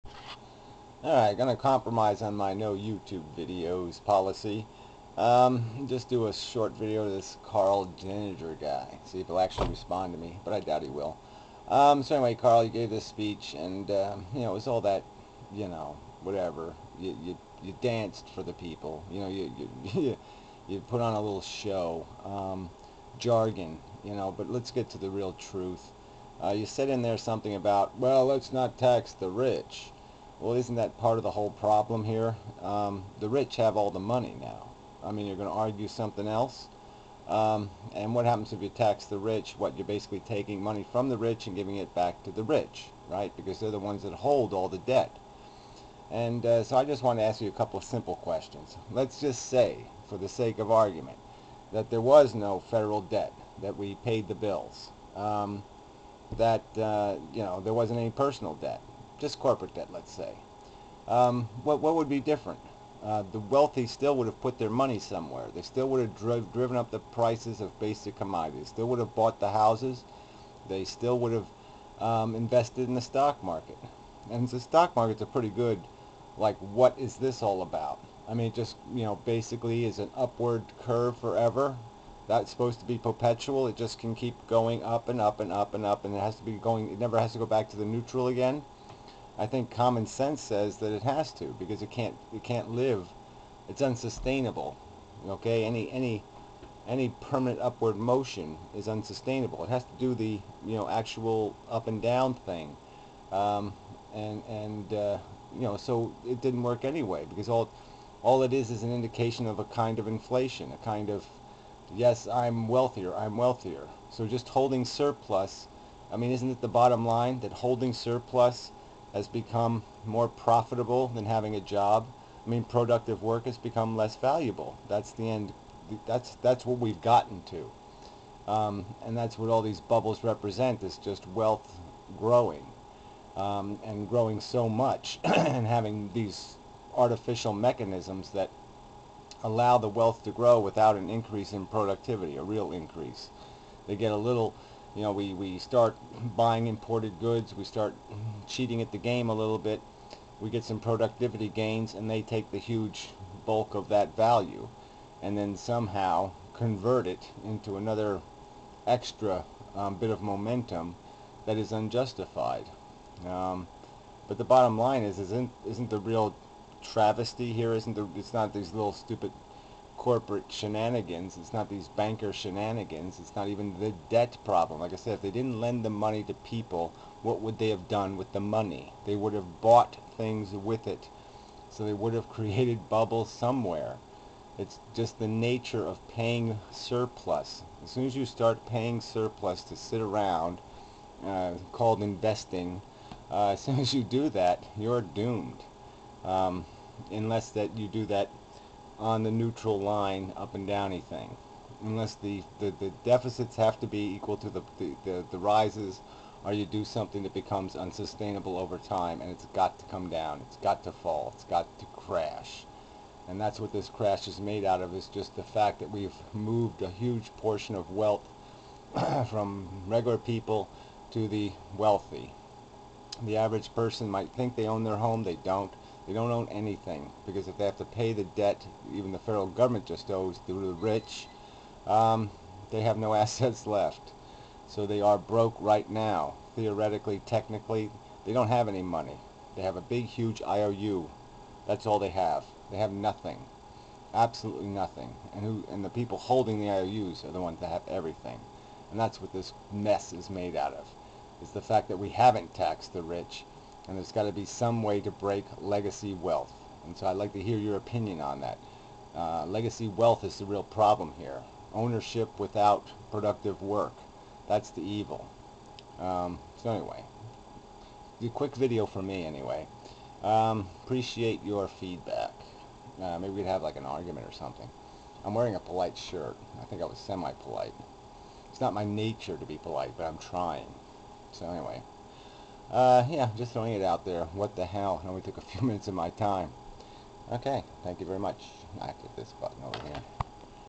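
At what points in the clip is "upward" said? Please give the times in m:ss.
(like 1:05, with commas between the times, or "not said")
1:20, 1:37.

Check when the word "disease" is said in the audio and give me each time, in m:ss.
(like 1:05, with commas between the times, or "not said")
not said.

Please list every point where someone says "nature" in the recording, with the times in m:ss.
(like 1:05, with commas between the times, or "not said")
3:05, 4:38.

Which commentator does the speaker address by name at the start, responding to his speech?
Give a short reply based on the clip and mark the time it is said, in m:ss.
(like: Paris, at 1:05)
Karl Denninger, at 0:07.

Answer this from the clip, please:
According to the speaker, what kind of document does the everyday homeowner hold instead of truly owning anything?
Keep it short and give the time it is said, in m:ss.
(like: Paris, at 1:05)
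IOU, at 3:59.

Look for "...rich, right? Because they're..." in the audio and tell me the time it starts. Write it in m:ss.
0:42.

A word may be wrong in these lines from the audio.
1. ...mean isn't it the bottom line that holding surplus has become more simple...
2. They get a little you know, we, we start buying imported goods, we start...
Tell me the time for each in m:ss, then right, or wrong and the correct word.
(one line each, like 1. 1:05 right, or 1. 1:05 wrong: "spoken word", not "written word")
1. 1:56 wrong: "profitable", not "simple"
2. 2:23 right.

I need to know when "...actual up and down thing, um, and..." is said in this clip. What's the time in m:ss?
1:40.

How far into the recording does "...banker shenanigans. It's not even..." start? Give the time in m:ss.
2:51.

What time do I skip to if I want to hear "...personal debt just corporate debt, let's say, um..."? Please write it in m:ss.
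0:58.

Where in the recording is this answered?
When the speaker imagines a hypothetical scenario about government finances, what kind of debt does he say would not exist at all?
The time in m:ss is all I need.
0:52.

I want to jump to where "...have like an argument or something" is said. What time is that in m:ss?
4:33.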